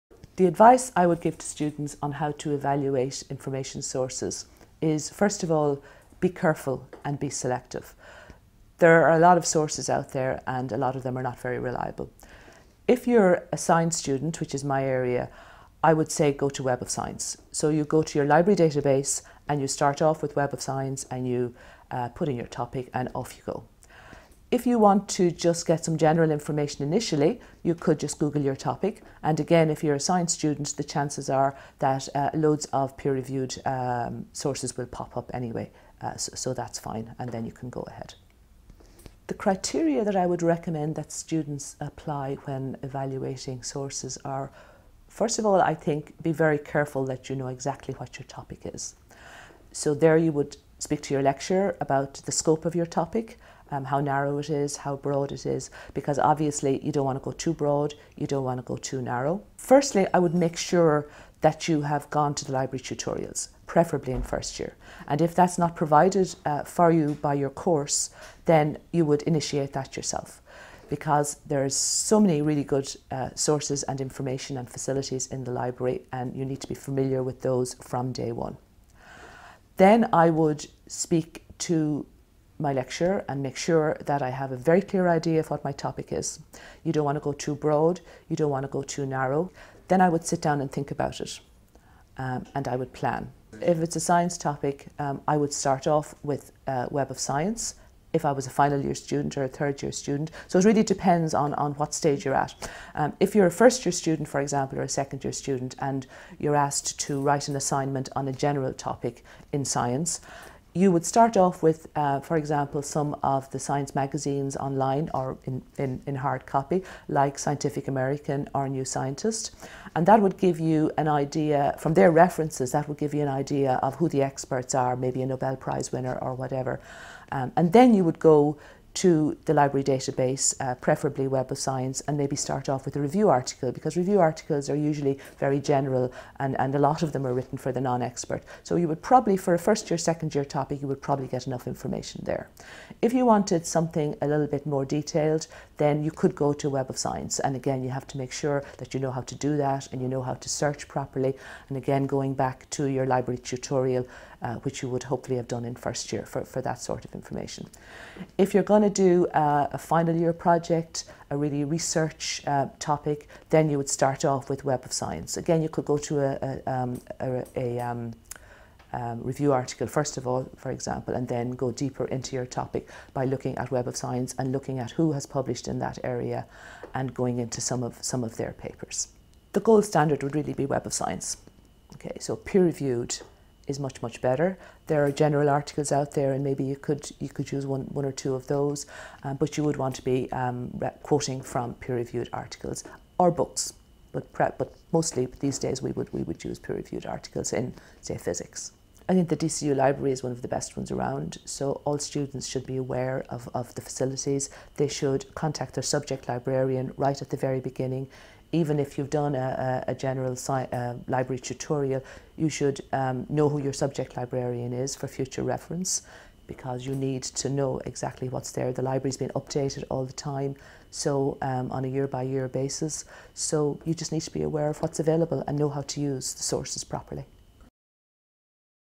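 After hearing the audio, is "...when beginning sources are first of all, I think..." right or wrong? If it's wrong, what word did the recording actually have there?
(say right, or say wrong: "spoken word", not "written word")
wrong: "evaluating", not "beginning".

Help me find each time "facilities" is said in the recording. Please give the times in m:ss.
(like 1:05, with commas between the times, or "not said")
1:14, 3:23.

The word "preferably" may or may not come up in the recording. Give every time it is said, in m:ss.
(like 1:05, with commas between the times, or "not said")
1:03, 2:10.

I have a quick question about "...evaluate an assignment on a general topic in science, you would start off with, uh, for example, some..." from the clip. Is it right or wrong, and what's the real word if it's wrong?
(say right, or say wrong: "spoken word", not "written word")
wrong: "write", not "evaluate".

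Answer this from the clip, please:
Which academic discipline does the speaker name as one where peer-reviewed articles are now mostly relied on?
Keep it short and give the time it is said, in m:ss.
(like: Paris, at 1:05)
Physics, at 3:18.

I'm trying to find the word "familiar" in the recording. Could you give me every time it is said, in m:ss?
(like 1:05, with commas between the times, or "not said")
1:16.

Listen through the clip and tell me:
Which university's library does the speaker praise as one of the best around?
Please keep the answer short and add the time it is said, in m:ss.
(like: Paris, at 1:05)
DCU, at 3:19.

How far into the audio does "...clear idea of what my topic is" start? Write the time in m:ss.
1:24.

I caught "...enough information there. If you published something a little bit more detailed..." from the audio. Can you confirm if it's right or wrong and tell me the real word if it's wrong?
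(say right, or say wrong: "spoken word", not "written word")
wrong: "wanted", not "published".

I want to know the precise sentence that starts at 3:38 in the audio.
The library's been updated all the time, so um, on a year by year basis.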